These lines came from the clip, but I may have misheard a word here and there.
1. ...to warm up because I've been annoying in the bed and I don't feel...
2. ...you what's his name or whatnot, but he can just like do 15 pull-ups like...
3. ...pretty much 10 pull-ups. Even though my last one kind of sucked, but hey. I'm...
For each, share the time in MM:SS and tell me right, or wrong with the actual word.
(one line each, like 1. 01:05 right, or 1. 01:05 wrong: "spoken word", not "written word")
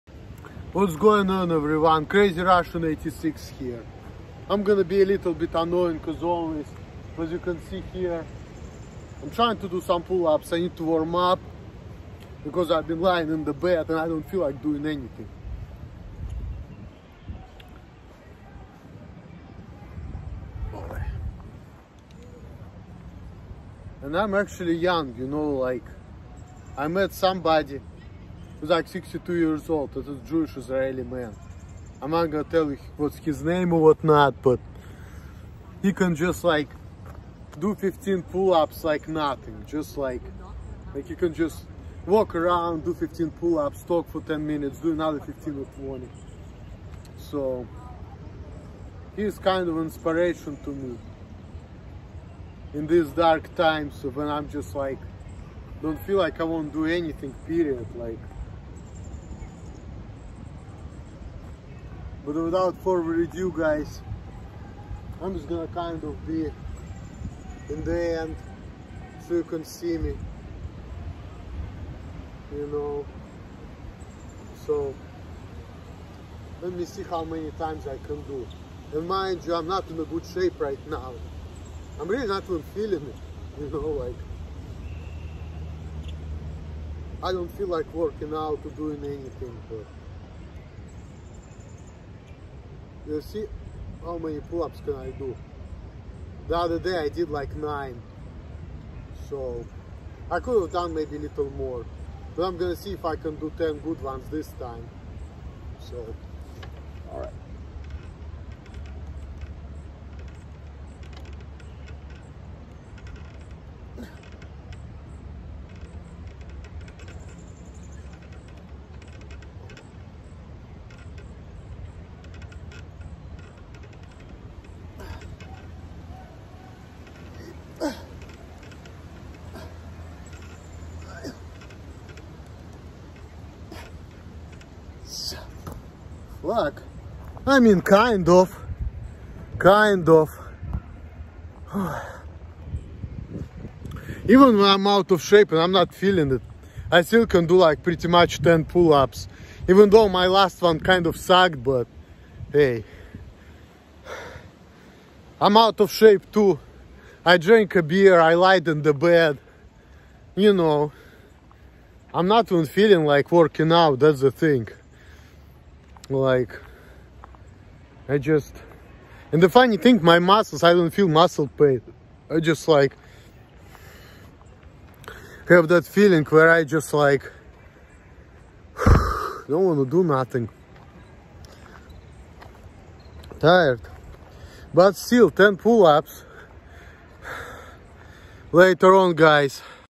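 1. 00:10 wrong: "lying", not "annoying"
2. 00:32 right
3. 02:27 right.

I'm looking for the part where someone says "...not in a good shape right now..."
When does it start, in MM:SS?
01:19.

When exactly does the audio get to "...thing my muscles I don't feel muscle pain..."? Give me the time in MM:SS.
02:49.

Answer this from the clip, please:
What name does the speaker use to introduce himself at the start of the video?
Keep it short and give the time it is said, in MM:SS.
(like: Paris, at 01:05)
Crazy Russian 86, at 00:02.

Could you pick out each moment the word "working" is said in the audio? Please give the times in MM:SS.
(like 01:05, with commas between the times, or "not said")
01:27, 02:43.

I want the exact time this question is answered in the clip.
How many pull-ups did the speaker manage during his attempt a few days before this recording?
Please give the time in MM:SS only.
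01:37.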